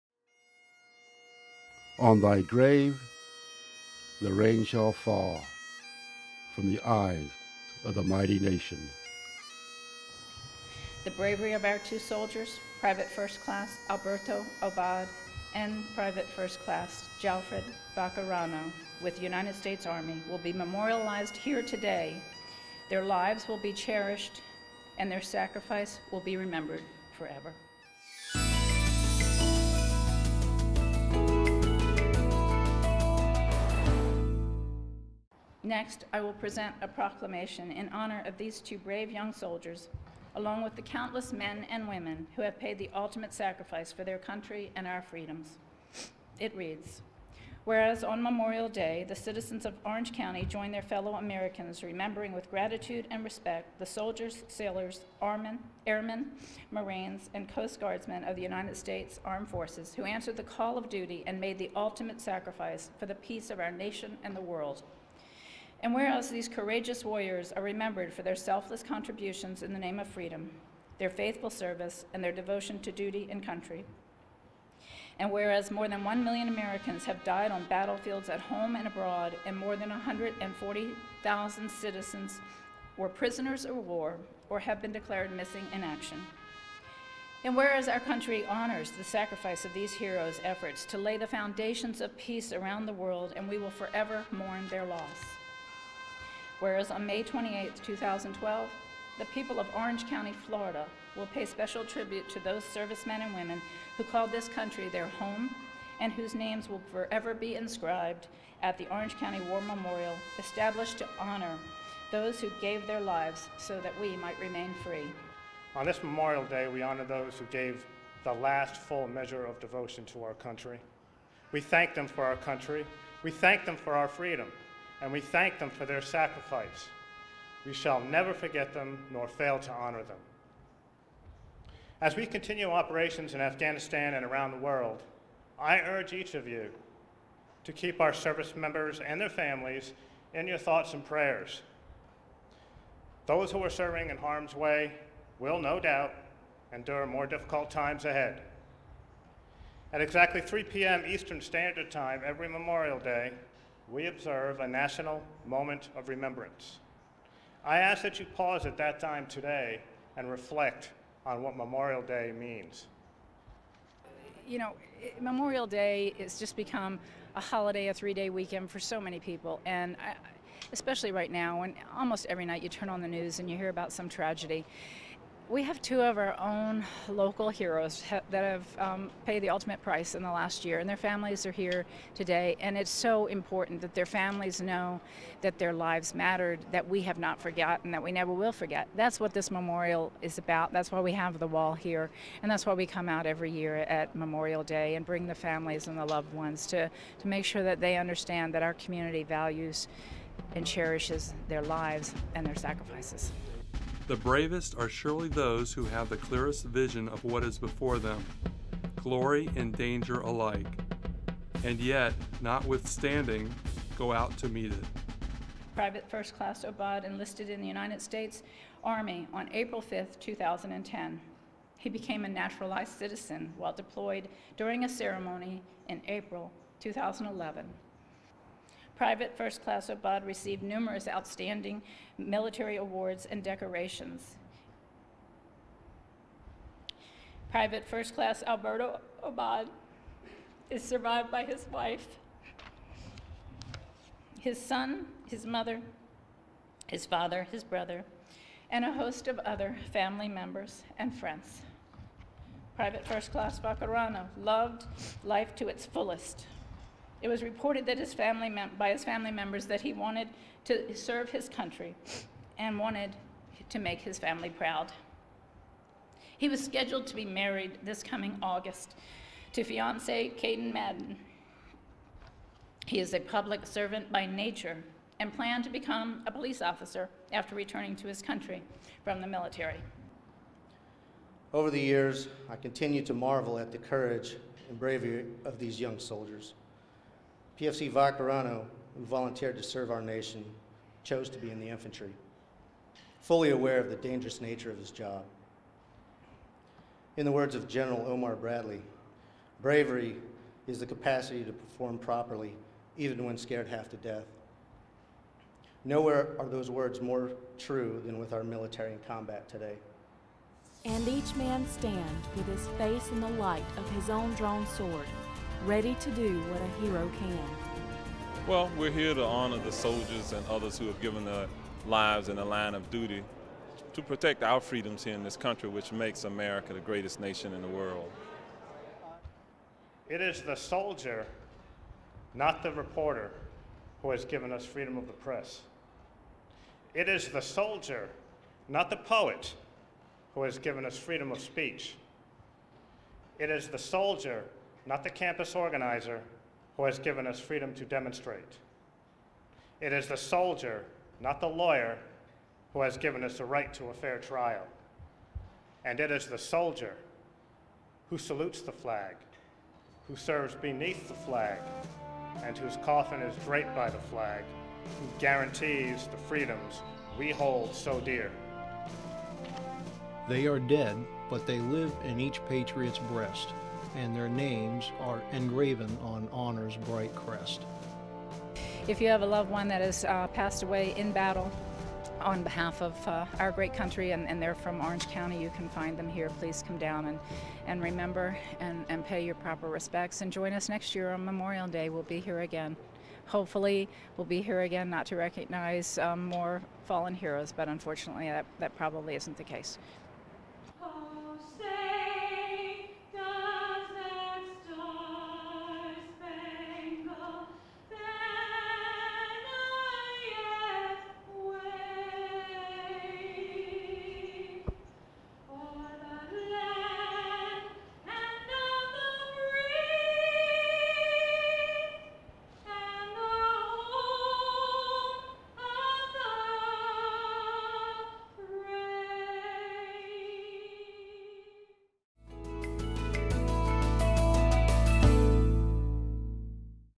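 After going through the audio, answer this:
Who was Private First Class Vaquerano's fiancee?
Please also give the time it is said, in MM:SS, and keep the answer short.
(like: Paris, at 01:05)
Caden Madden, at 04:30.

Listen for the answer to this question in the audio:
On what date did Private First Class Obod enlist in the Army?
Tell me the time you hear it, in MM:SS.
03:39.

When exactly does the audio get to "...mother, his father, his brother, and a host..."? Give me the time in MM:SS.
04:05.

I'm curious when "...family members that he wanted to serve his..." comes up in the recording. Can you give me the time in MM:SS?
04:19.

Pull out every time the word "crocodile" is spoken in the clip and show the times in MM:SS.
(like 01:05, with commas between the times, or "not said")
not said.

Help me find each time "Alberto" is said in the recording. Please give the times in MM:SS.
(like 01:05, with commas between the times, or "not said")
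00:13, 03:58.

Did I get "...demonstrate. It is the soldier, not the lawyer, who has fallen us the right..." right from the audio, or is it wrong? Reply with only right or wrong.
wrong.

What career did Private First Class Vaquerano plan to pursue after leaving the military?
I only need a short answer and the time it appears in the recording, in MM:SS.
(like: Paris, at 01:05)
police officer, at 04:36.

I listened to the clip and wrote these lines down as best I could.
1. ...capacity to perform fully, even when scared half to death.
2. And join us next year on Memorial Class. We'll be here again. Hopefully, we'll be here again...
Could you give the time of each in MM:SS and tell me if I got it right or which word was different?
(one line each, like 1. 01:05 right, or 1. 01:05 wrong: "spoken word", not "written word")
1. 05:00 wrong: "properly", not "fully"
2. 06:30 wrong: "Day", not "Class".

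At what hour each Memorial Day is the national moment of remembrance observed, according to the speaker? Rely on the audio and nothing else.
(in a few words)
3 p.m.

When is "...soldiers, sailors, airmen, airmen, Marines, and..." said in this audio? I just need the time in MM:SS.
00:53.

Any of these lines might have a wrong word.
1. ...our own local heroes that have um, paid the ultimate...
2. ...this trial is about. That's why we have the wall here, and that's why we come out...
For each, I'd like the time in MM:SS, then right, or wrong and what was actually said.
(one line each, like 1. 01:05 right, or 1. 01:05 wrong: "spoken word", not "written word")
1. 02:56 right
2. 03:09 wrong: "memorial", not "trial".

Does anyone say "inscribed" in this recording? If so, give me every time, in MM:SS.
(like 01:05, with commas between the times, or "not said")
01:47.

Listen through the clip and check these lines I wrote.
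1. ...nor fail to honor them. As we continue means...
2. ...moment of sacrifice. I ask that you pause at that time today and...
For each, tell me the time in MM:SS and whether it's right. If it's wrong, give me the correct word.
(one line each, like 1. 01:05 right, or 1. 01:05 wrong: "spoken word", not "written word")
1. 02:09 wrong: "operations", not "means"
2. 02:35 wrong: "remembrance", not "sacrifice".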